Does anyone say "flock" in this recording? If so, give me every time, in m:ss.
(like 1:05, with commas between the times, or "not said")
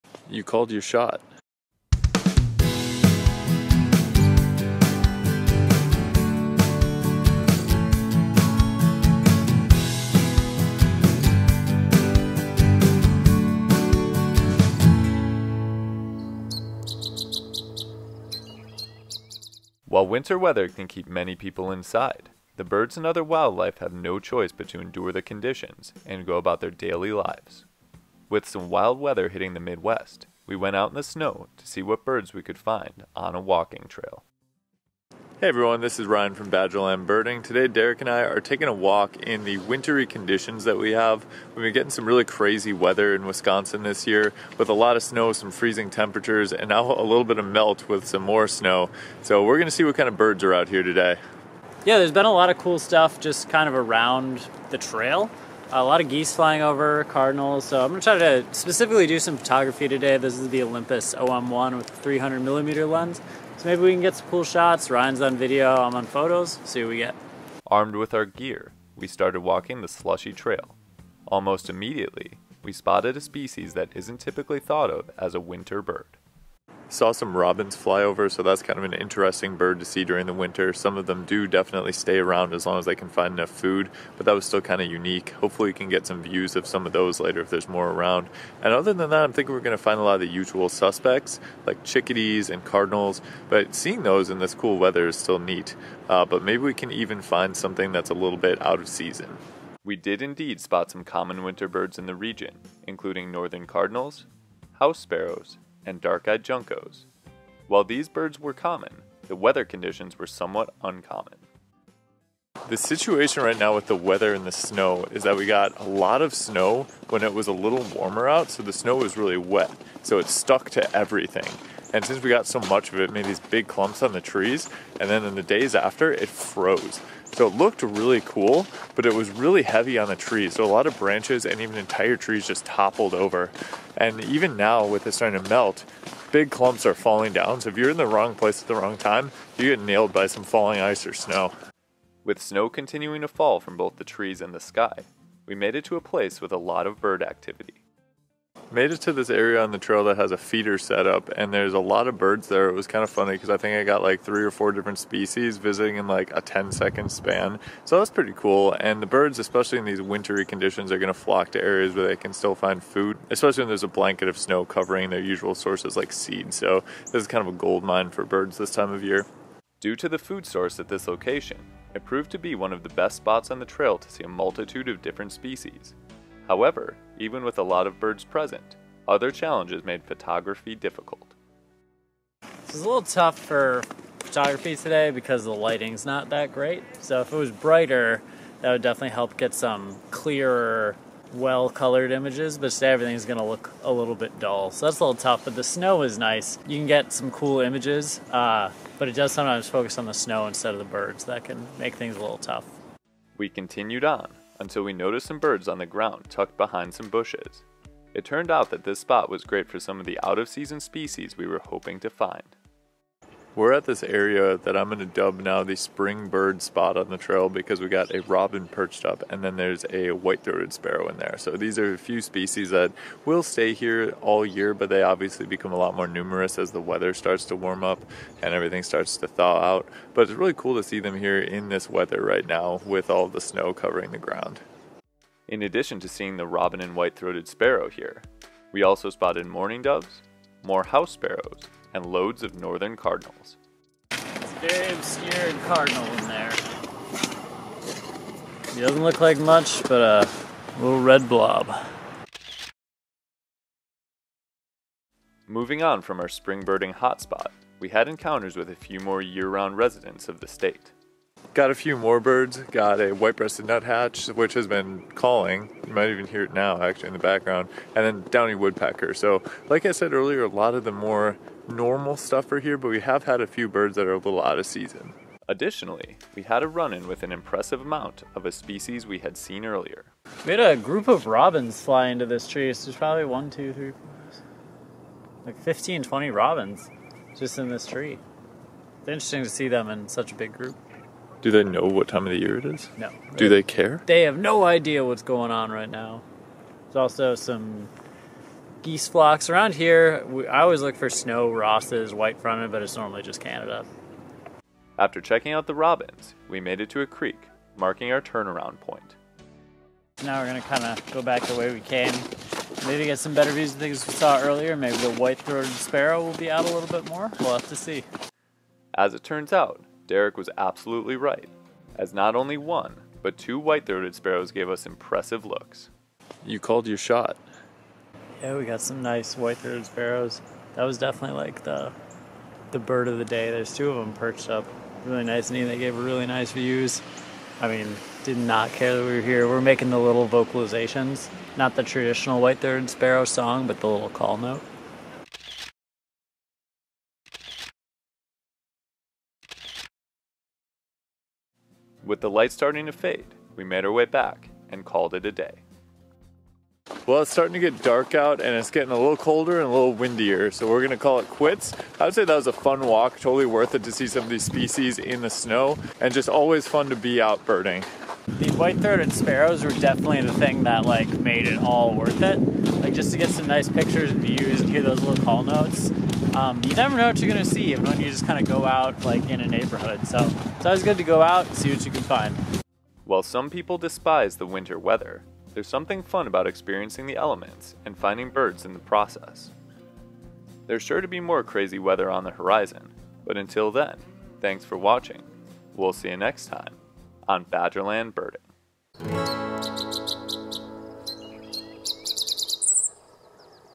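2:41, 4:59.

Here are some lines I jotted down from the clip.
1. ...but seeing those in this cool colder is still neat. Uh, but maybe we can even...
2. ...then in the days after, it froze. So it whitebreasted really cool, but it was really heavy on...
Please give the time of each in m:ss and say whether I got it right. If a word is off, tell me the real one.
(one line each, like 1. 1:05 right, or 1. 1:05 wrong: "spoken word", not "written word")
1. 1:33 wrong: "weather", not "colder"
2. 2:05 wrong: "looked", not "whitebreasted".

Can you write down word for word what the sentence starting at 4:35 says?
Additionally, we had a run-in with an impressive amount of a species we had seen earlier.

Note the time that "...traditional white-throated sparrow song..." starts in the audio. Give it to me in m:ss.
5:41.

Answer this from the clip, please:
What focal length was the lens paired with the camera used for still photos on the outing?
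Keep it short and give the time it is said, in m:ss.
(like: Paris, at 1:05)
300 millimeter, at 1:01.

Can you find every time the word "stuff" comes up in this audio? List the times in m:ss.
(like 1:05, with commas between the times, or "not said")
0:52, 4:32.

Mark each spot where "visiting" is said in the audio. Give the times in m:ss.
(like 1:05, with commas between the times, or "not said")
2:35.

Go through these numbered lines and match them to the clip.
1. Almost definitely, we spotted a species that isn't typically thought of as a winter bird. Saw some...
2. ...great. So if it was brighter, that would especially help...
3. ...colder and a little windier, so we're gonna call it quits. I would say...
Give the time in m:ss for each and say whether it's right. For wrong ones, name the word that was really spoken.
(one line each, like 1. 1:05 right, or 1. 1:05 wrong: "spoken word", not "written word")
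1. 1:11 wrong: "immediately", not "definitely"
2. 3:06 wrong: "definitely", not "especially"
3. 5:59 right.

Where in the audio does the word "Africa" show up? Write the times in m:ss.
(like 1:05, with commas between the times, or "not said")
not said.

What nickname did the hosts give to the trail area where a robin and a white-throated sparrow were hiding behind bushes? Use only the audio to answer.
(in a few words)
the spring bird spot.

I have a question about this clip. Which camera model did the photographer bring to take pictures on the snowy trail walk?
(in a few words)
Olympus OM1.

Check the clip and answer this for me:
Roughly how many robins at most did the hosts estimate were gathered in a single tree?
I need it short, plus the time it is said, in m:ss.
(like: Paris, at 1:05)
20, at 4:46.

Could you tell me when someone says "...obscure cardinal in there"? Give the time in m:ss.
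4:05.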